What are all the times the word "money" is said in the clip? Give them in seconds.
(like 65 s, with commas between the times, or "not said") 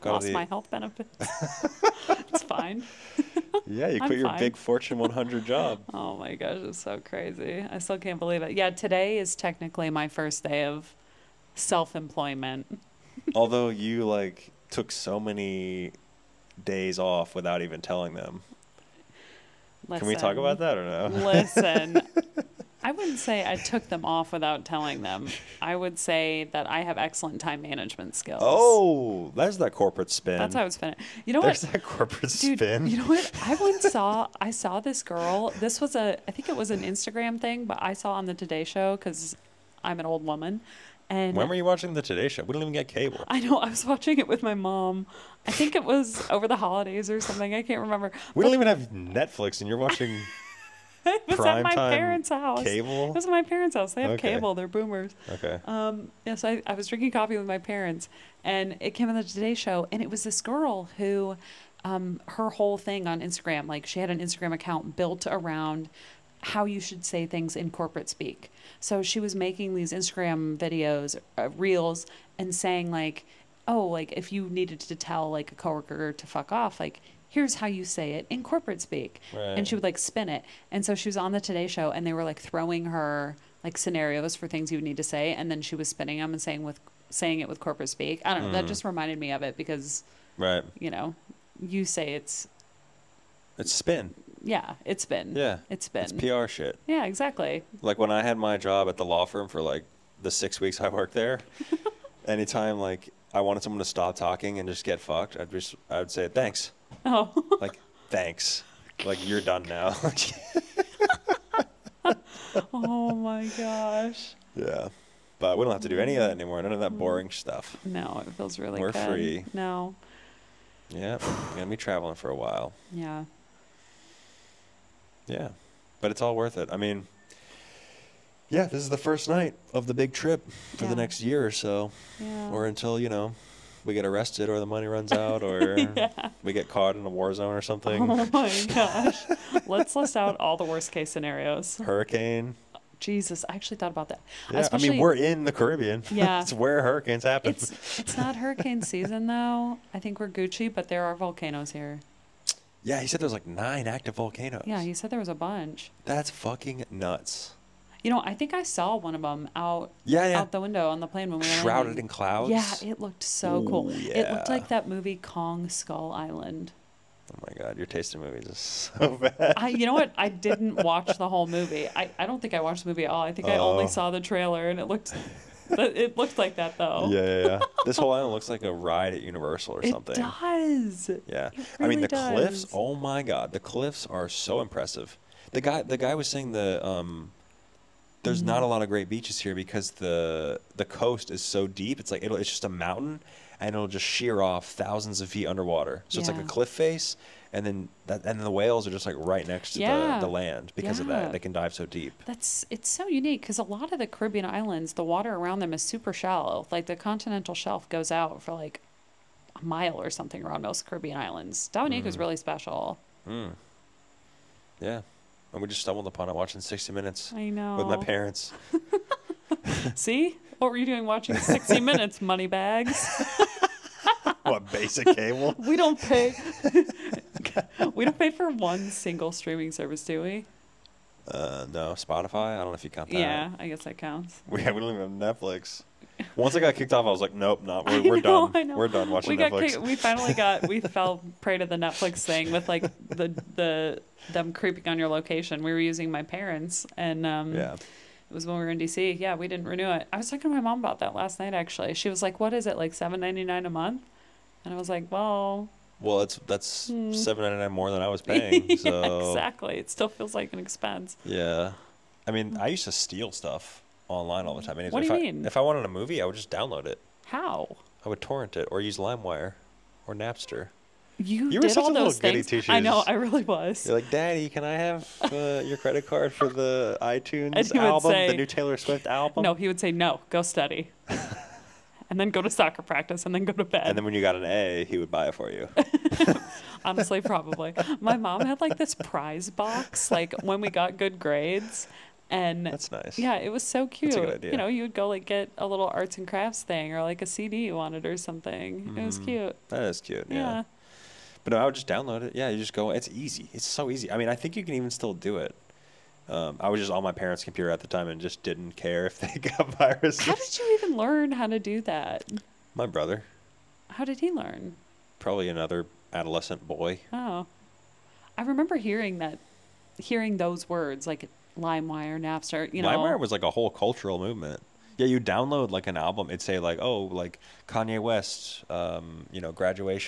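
134 s, 222 s.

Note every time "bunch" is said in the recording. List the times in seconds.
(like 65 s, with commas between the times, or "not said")
155 s.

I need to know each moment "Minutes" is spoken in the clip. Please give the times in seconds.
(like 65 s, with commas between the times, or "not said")
216 s, 221 s.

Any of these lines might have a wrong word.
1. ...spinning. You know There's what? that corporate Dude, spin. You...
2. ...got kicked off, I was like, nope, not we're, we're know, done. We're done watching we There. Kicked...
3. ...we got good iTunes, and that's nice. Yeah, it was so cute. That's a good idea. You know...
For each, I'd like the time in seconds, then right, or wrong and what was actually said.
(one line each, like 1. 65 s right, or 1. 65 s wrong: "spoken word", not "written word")
1. 30 s right
2. 236 s wrong: "Netflix", not "There"
3. 290 s wrong: "grades", not "iTunes".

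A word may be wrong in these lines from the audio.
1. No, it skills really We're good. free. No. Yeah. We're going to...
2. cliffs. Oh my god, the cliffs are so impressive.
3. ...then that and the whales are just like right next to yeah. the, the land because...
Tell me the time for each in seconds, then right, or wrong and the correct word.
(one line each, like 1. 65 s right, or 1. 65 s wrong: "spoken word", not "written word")
1. 117 s wrong: "feels", not "skills"
2. 182 s right
3. 197 s right.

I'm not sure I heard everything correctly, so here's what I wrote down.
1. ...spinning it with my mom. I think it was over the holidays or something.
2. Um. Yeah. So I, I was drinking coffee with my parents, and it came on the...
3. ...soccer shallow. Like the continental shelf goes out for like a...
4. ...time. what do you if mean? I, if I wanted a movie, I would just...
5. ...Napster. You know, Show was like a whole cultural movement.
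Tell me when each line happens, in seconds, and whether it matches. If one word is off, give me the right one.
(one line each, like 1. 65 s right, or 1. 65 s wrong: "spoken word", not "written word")
1. 43 s wrong: "watching", not "spinning"
2. 55 s right
3. 205 s wrong: "super", not "soccer"
4. 264 s right
5. 322 s wrong: "LimeWire", not "Show".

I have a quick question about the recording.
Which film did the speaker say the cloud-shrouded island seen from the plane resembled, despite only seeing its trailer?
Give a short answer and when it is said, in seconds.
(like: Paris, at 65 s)
Kong Skull Island, at 165 s.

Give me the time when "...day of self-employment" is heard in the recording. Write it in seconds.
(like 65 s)
10 s.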